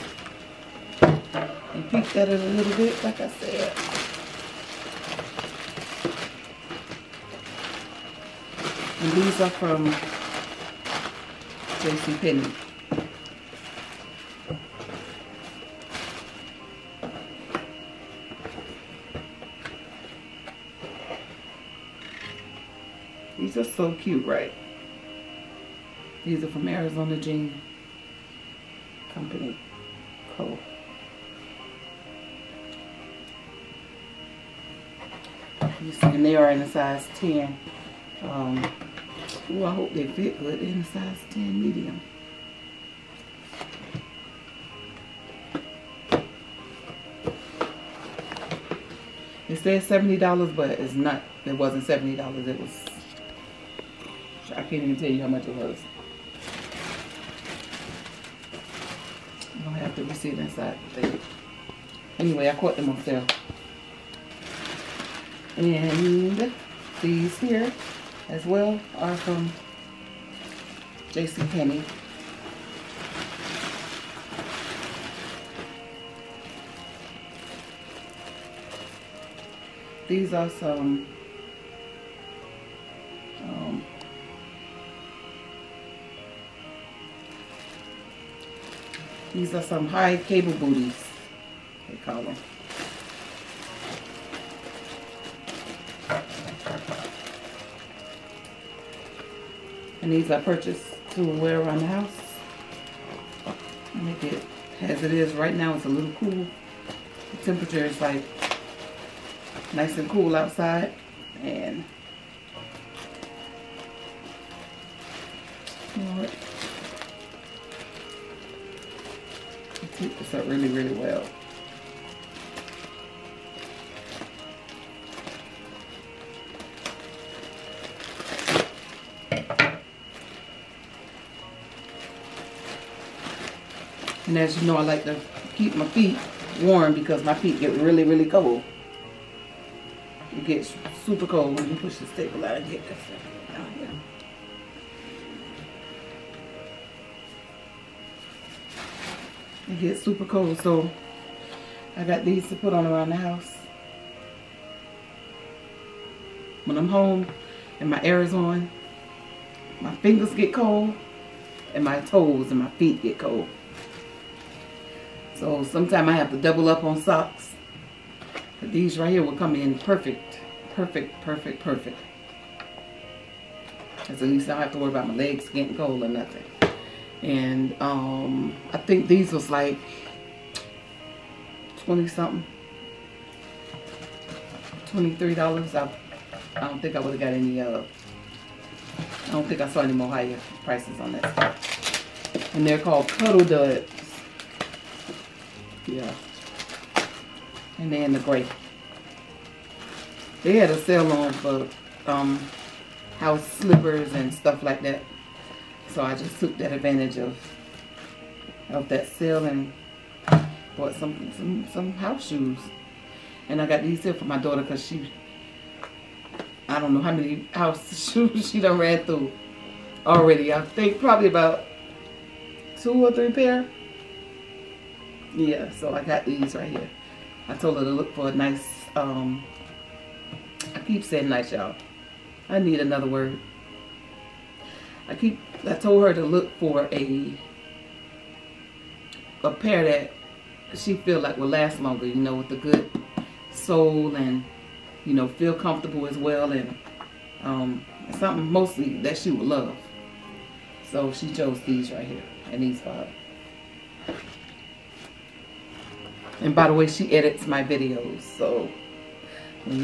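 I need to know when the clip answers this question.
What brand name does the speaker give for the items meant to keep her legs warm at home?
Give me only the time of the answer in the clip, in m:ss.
3:13.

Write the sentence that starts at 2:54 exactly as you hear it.
Because at least I don't have to worry about my legs getting cold or nothing.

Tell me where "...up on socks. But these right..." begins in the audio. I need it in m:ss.
2:46.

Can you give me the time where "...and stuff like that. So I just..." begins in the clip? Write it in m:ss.
3:24.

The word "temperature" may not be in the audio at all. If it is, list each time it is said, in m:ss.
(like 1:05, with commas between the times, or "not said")
1:47.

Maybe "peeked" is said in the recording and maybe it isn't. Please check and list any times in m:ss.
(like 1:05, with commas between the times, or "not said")
0:01.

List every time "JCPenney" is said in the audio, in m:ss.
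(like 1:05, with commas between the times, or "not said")
0:11, 1:11.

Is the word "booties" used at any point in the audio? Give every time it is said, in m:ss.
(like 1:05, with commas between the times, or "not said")
1:30.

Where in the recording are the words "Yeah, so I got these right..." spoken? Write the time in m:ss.
3:45.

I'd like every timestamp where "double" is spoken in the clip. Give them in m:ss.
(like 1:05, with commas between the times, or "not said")
2:46.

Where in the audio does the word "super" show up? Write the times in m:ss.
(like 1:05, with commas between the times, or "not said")
2:21, 2:30.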